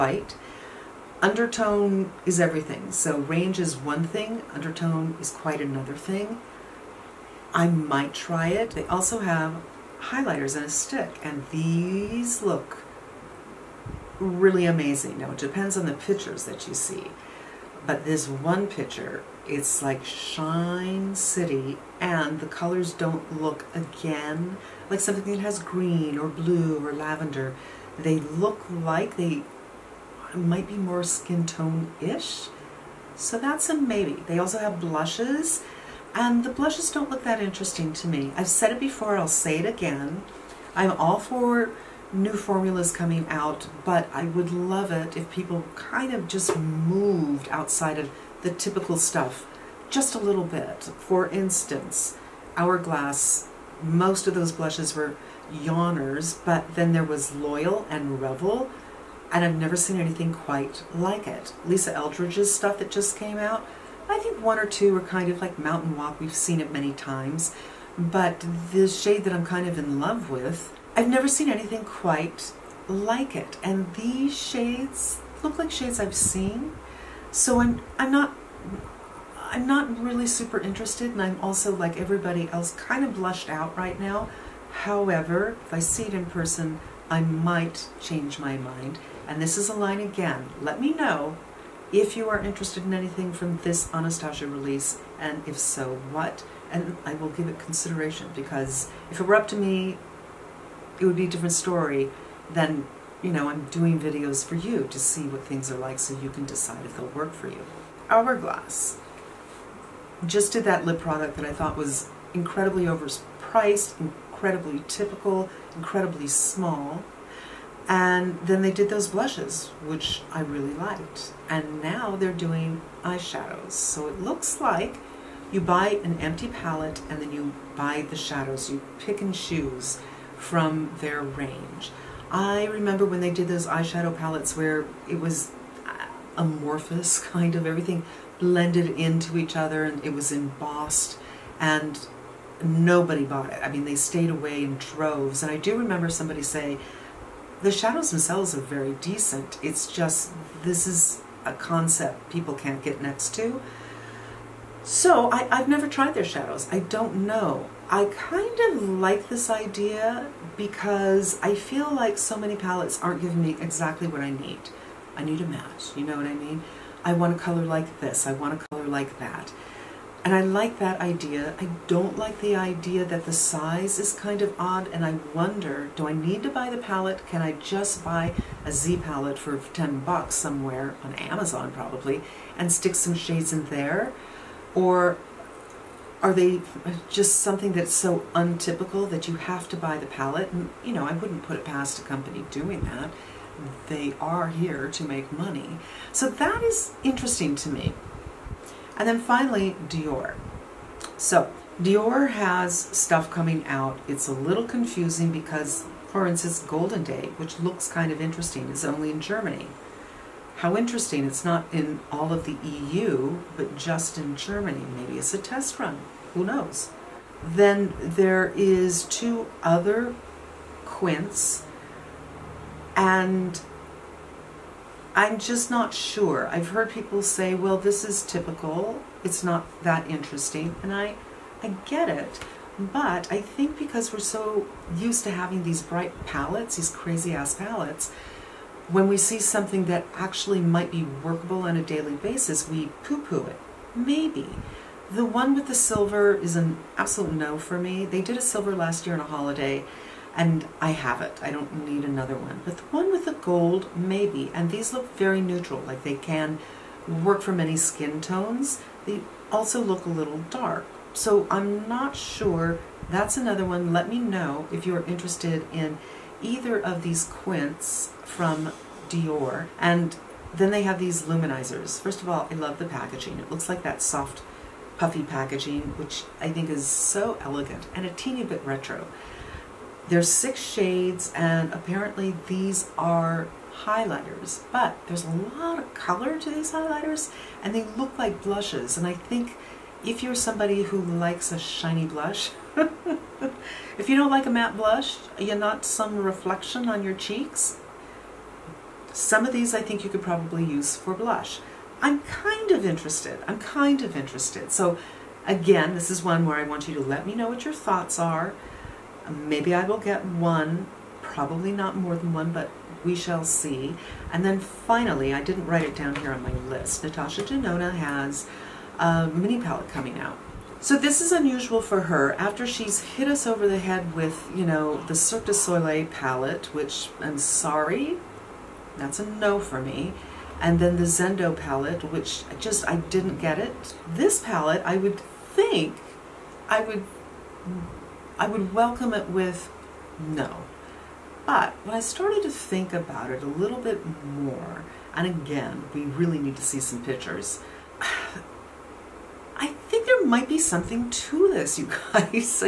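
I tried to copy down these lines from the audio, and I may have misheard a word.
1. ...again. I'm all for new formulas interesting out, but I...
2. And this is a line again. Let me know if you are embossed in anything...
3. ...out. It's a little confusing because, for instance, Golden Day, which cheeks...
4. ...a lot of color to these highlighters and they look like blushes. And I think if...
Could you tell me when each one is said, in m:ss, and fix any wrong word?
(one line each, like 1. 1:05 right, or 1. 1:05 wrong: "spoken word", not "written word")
1. 0:39 wrong: "coming", not "interesting"
2. 1:29 wrong: "interested", not "embossed"
3. 3:23 wrong: "looks", not "cheeks"
4. 4:45 right.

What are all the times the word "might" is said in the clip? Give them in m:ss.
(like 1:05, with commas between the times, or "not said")
0:07, 0:30, 1:27, 4:00, 5:50.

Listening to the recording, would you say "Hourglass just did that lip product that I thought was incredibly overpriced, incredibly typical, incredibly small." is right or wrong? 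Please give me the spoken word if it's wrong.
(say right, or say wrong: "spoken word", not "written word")
right.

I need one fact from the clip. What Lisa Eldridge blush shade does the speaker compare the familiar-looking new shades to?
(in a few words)
Mountain Walk.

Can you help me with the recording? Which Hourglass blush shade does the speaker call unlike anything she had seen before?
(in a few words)
Loyal.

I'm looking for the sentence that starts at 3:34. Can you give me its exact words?
Maybe it's a test run, who knows?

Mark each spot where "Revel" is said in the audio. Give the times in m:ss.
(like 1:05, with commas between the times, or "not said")
0:58.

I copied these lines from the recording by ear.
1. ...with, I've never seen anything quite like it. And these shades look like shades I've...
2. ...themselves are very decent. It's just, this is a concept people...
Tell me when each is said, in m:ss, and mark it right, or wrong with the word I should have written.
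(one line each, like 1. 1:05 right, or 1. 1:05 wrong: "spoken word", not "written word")
1. 1:10 right
2. 2:28 right.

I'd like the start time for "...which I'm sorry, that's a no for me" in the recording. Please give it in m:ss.
5:26.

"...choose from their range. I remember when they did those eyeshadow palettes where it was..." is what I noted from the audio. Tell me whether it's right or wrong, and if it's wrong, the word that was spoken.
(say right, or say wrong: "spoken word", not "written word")
right.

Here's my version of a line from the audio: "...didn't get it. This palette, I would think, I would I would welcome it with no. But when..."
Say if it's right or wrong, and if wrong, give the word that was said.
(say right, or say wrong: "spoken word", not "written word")
right.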